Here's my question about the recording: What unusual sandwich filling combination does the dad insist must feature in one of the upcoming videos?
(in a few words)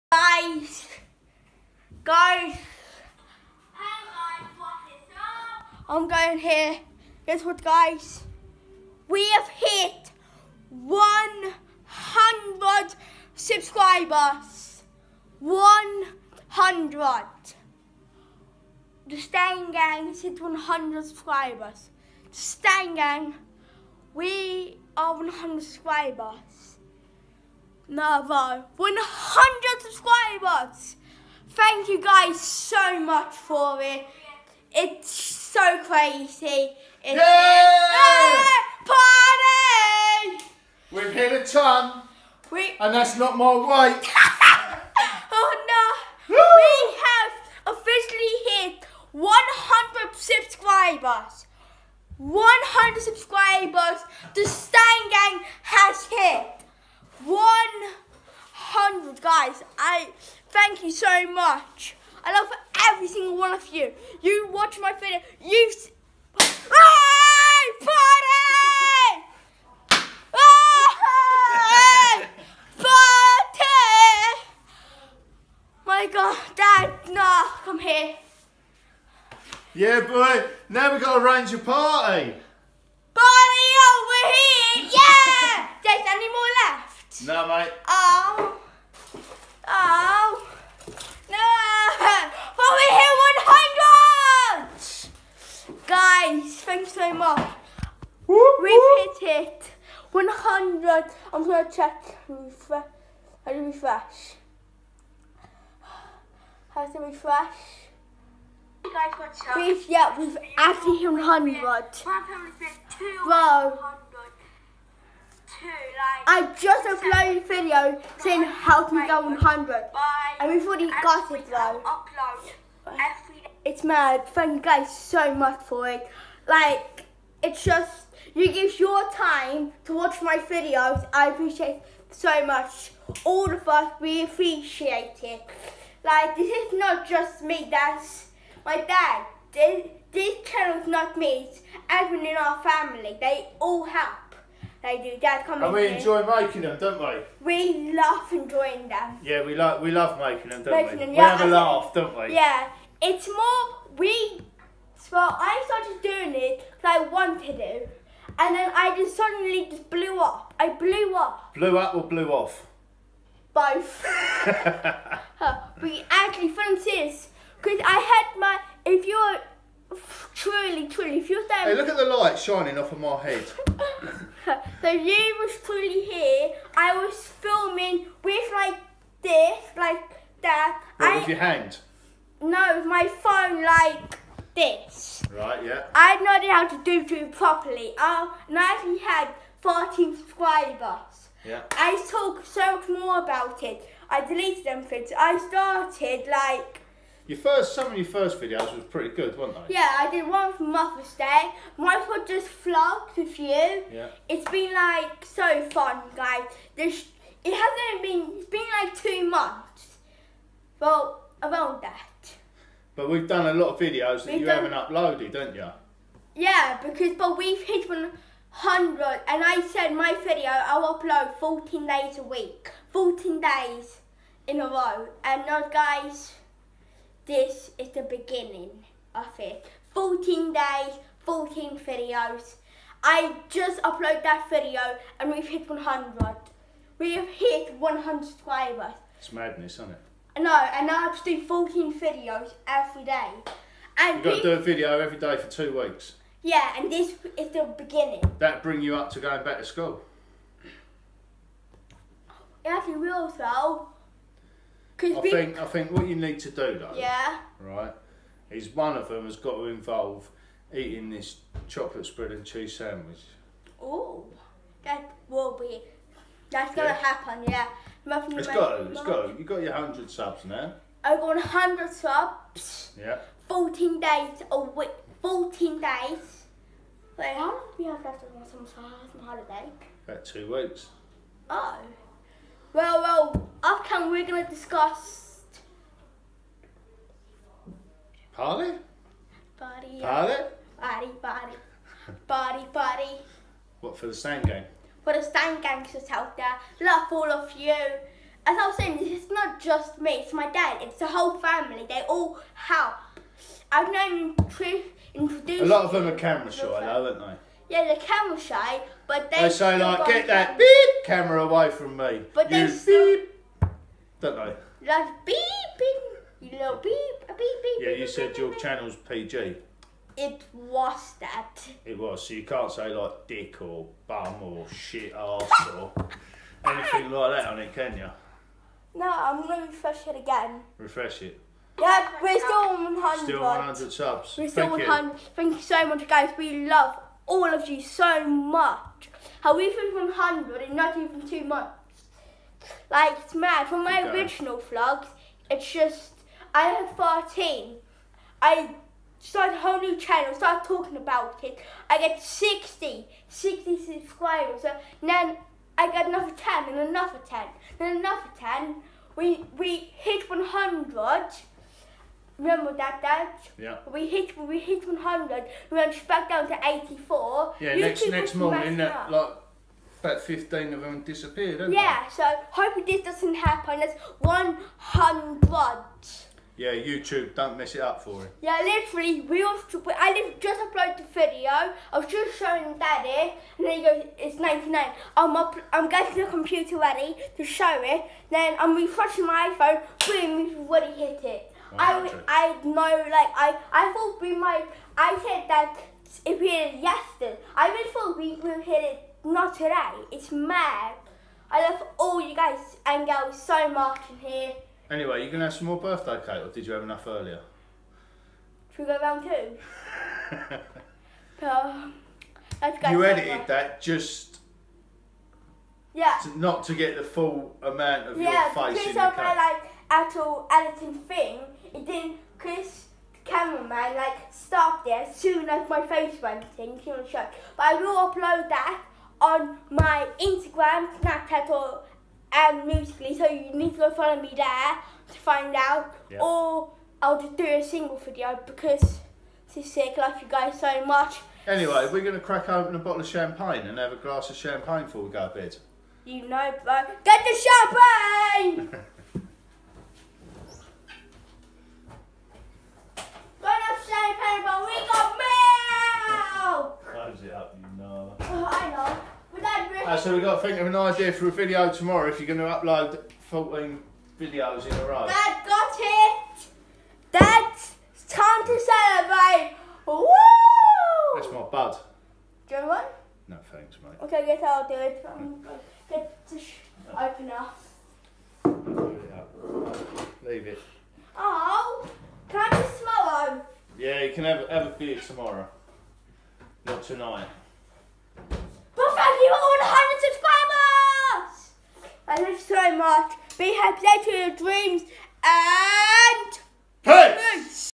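Chocolate spread and cheese.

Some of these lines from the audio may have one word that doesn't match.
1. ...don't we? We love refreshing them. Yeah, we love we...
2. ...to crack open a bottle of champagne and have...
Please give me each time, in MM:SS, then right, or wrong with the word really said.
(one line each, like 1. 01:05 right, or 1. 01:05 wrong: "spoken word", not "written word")
1. 02:26 wrong: "enjoying", not "refreshing"
2. 07:22 right.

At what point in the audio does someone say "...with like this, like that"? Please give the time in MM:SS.
02:58.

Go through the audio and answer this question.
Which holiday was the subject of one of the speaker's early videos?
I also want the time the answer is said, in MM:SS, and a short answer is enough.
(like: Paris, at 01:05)
Mother's Day, at 03:20.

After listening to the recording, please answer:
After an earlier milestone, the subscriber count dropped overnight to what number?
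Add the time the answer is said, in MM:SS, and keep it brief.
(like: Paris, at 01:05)
84, at 06:05.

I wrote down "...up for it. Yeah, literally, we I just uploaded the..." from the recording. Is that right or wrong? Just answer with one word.
right.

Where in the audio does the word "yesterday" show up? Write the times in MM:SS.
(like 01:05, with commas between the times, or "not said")
06:36.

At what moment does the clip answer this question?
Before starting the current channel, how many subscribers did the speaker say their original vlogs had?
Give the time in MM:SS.
03:08.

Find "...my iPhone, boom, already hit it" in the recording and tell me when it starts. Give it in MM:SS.
06:29.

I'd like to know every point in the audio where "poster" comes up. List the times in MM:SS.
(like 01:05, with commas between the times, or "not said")
not said.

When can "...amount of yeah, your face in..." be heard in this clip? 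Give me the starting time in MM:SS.
06:57.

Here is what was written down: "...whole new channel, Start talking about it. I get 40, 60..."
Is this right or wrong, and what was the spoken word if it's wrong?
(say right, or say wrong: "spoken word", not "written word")
wrong: "60", not "40".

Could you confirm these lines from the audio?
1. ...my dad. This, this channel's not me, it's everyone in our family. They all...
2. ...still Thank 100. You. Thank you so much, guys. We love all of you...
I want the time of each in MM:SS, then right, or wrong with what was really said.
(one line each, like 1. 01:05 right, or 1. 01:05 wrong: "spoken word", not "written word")
1. 02:18 right
2. 05:34 right.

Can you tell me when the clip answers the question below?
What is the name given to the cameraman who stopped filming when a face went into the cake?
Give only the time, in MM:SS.
07:02.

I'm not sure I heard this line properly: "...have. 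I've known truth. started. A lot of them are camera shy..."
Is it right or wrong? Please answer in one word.
wrong.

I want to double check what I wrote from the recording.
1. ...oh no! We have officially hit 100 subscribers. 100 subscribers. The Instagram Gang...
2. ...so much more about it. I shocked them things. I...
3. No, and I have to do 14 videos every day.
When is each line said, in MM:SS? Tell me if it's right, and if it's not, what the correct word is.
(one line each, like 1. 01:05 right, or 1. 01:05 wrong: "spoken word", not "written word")
1. 00:45 wrong: "Stein", not "Instagram"
2. 03:12 wrong: "deleted", not "shocked"
3. 04:00 right.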